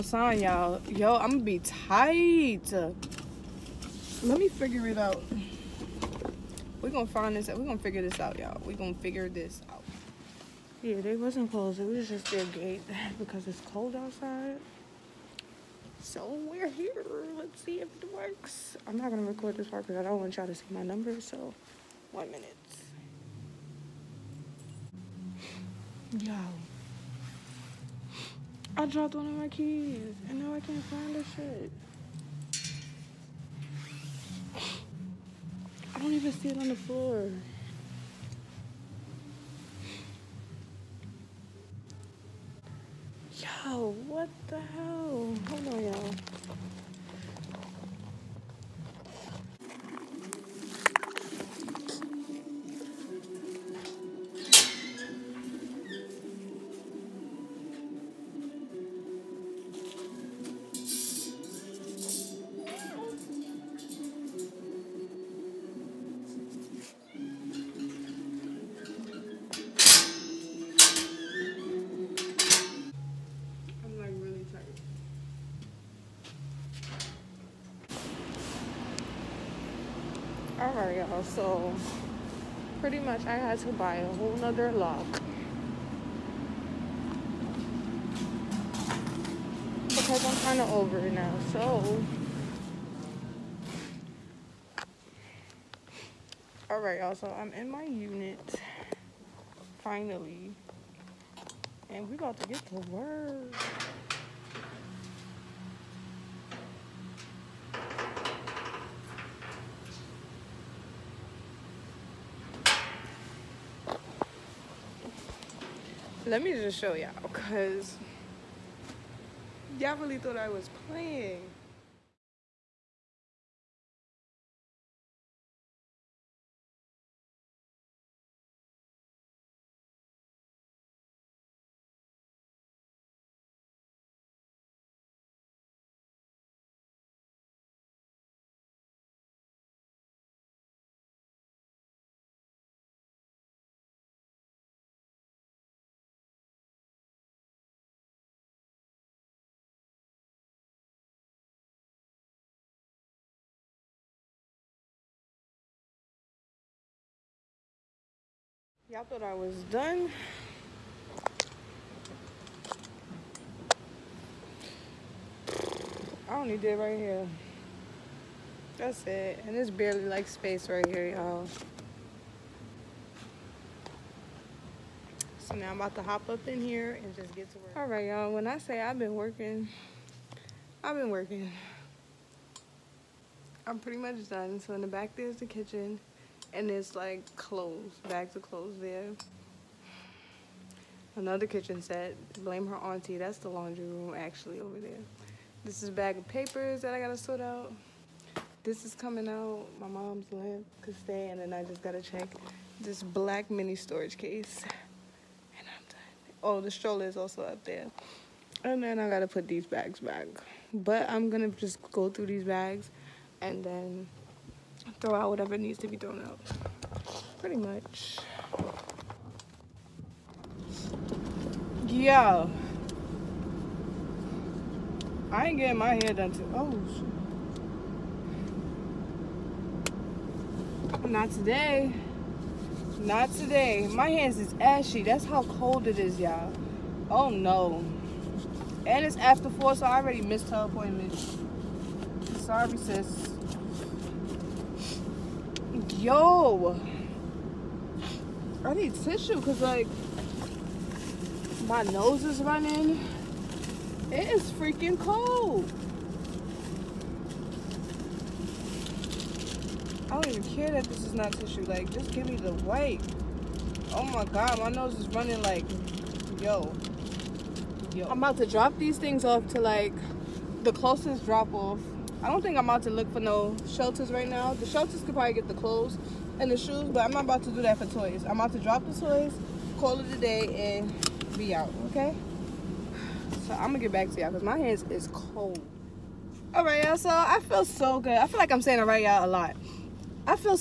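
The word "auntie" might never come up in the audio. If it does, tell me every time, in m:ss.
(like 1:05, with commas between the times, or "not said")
3:12.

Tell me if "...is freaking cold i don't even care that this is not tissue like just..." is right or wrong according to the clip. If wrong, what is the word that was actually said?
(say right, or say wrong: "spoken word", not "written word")
right.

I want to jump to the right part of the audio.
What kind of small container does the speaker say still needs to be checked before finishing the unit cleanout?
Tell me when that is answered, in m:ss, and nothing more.
3:23.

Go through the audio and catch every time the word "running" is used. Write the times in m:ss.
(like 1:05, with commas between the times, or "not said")
4:12, 4:25.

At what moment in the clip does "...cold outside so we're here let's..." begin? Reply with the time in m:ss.
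0:13.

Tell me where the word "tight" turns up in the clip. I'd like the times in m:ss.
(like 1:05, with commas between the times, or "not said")
0:01.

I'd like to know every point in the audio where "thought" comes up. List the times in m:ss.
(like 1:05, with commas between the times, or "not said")
2:00, 2:39.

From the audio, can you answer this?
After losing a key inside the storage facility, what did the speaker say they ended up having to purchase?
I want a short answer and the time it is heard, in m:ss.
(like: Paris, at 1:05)
A whole nother lock, at 1:23.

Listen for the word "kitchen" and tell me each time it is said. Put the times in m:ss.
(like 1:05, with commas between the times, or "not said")
3:05, 3:11.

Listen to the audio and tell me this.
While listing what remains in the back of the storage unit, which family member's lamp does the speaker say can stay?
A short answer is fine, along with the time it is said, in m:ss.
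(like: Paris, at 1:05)
Mom's lamp, at 3:19.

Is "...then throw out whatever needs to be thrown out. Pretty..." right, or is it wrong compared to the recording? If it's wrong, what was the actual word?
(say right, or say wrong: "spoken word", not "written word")
right.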